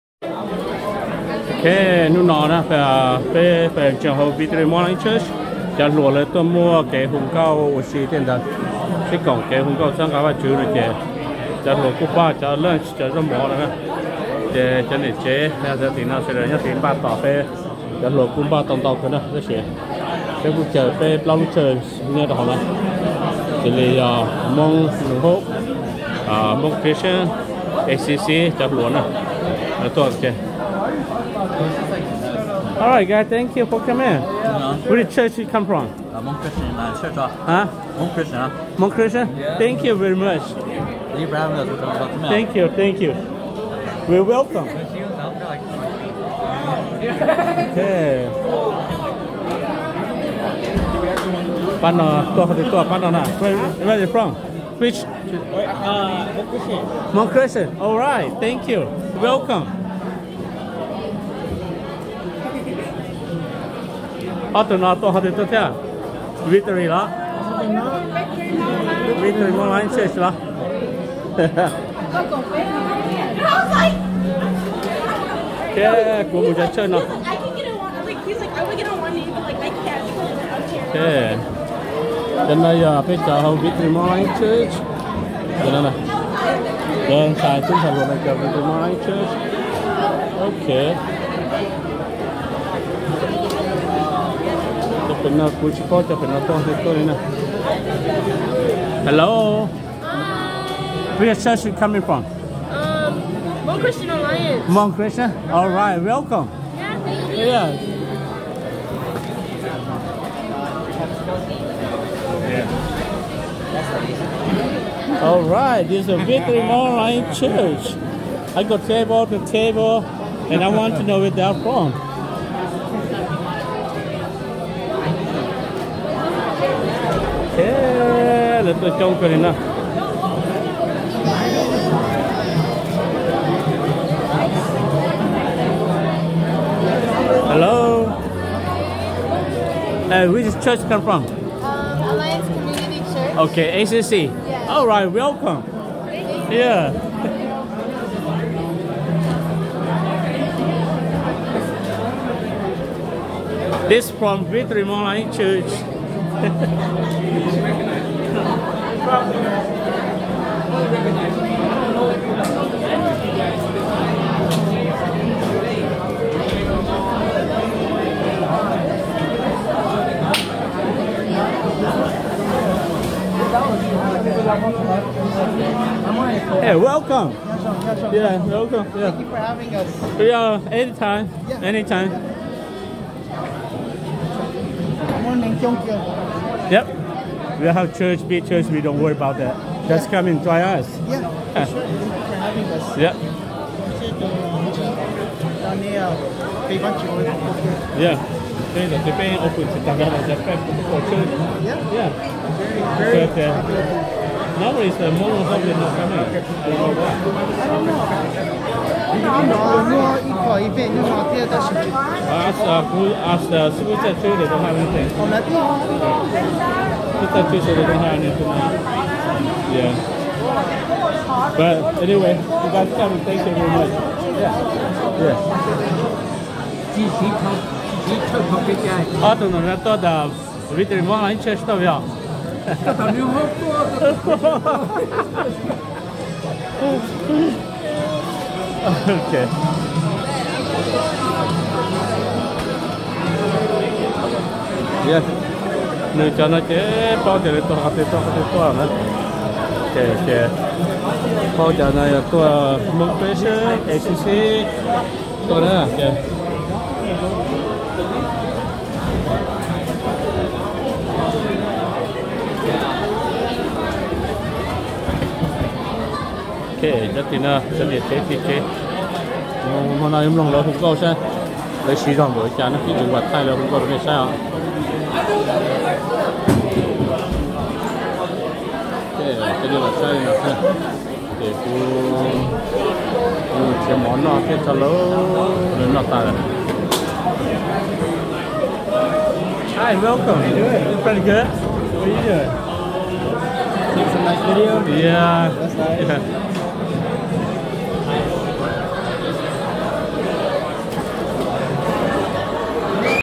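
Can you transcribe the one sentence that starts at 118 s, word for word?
I got table to table, and I want to know where they're from.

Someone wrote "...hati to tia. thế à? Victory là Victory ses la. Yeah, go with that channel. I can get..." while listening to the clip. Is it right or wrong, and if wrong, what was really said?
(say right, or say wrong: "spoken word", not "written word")
right.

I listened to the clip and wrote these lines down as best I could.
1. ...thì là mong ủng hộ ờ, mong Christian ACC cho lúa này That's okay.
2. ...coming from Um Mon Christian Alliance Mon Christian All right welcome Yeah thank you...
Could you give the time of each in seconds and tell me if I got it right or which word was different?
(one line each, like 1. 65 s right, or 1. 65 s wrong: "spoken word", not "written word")
1. 23 s right
2. 101 s right.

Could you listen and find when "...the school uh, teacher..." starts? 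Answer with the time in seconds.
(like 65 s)
213 s.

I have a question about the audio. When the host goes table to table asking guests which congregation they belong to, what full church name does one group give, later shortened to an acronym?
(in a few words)
Alliance Community Church.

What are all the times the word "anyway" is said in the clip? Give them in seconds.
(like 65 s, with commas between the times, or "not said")
222 s.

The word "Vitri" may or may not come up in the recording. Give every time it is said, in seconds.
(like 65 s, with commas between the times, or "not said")
154 s.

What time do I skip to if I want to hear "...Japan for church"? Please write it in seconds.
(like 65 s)
200 s.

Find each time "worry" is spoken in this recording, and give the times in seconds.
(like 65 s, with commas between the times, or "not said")
188 s.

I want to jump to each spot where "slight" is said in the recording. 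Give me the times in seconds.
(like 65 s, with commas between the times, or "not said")
not said.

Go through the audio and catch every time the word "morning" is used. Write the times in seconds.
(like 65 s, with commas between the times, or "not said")
4 s, 83 s, 88 s, 185 s.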